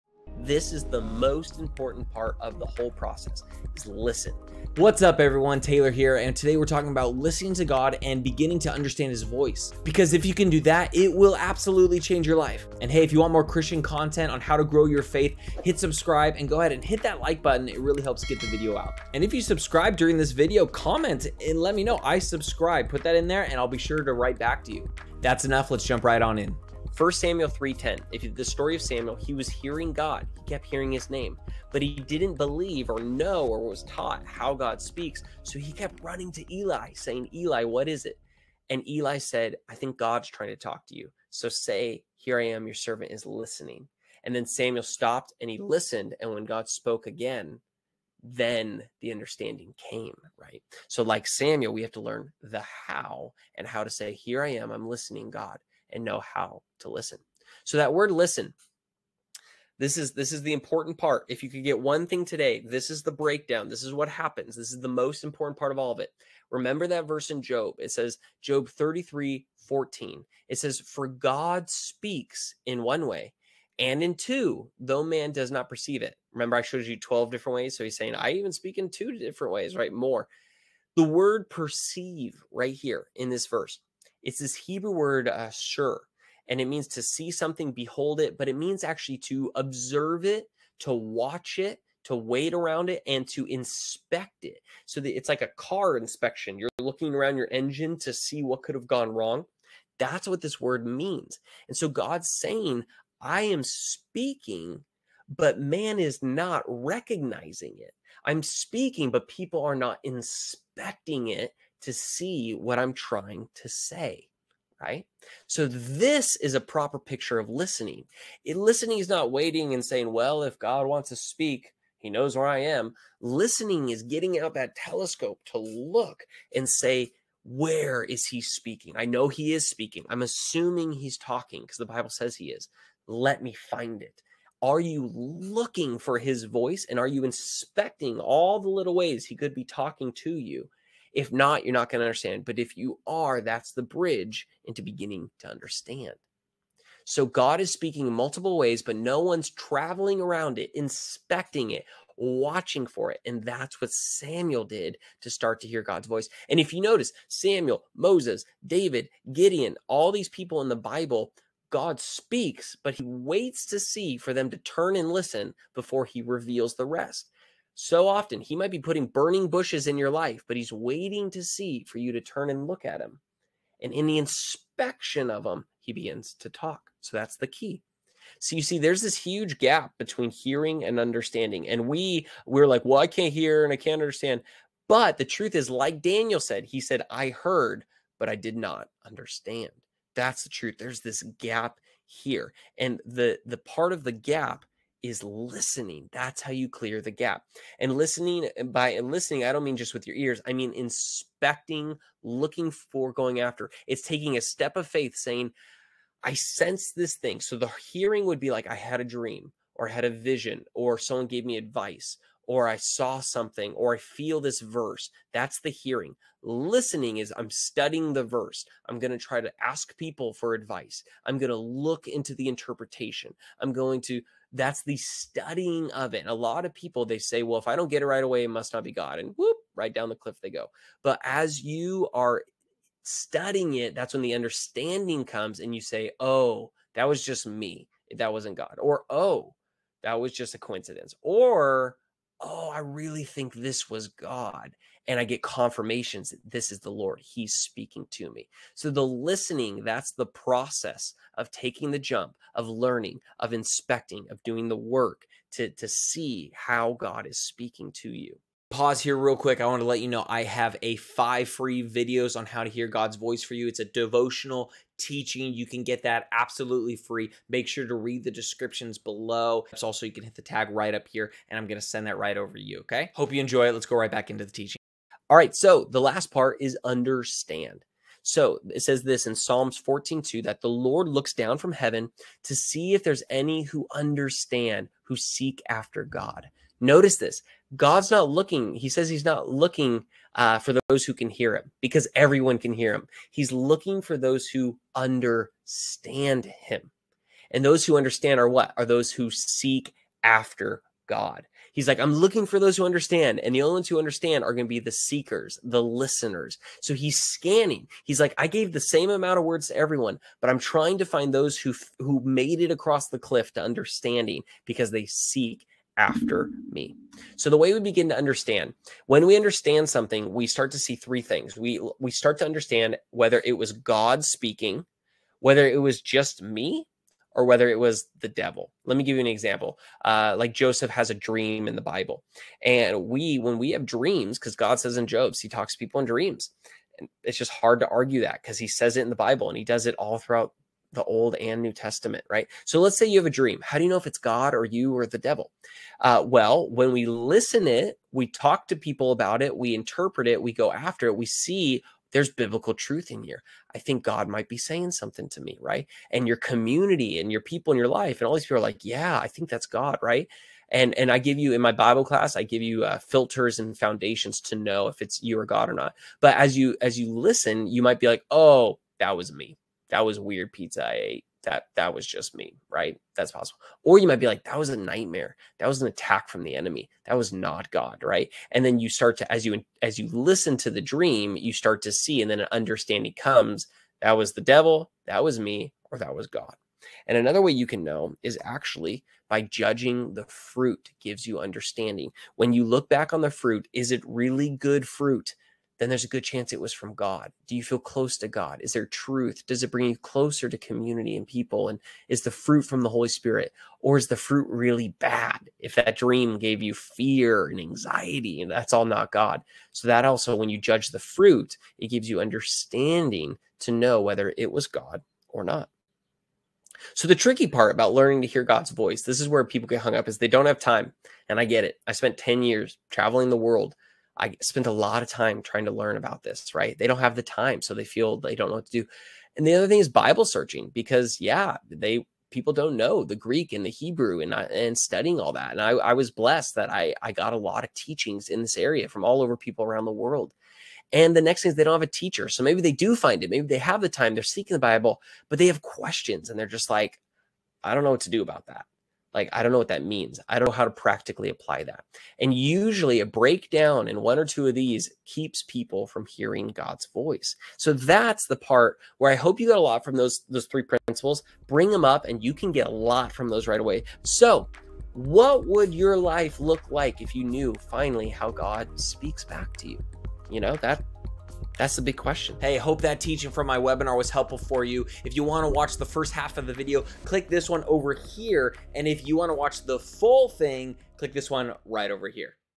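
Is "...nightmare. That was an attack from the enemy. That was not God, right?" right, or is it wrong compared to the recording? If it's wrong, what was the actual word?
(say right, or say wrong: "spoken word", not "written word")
right.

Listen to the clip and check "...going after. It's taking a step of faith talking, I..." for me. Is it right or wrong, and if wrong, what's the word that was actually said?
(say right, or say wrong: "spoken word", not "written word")
wrong: "saying", not "talking".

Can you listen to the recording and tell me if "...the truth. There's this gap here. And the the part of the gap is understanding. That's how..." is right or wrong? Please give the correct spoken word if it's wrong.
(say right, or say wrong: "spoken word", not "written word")
wrong: "listening", not "understanding".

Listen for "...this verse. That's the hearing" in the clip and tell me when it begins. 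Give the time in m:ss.
3:34.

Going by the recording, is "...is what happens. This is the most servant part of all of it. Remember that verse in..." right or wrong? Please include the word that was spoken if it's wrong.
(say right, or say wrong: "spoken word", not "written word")
wrong: "important", not "servant".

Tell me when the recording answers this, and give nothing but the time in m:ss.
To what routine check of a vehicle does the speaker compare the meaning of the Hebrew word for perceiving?
1:35.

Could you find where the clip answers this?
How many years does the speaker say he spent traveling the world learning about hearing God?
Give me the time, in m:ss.
7:02.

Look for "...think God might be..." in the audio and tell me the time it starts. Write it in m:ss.
5:53.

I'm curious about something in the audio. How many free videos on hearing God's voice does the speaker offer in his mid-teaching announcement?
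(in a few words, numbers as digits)
5.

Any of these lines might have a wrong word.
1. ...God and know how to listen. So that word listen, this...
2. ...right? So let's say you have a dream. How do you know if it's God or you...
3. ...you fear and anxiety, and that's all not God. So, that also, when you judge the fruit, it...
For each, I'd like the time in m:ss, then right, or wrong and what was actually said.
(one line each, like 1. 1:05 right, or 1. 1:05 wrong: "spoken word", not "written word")
1. 0:55 right
2. 5:42 right
3. 6:46 right.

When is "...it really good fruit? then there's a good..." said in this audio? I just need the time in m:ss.
6:33.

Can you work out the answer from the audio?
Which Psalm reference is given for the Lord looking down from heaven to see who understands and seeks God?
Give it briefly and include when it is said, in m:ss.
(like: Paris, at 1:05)
Psalms 14:2, at 4:39.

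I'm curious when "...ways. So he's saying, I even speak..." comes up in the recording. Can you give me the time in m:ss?
1:17.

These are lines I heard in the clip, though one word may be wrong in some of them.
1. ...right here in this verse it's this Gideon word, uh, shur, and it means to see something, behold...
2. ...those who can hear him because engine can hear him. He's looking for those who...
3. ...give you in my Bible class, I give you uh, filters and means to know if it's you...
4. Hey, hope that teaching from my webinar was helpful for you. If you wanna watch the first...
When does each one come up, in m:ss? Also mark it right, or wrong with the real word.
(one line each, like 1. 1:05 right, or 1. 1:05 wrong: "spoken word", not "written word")
1. 1:22 wrong: "Hebrew", not "Gideon"
2. 4:50 wrong: "everyone", not "engine"
3. 6:01 wrong: "foundations", not "means"
4. 7:52 right.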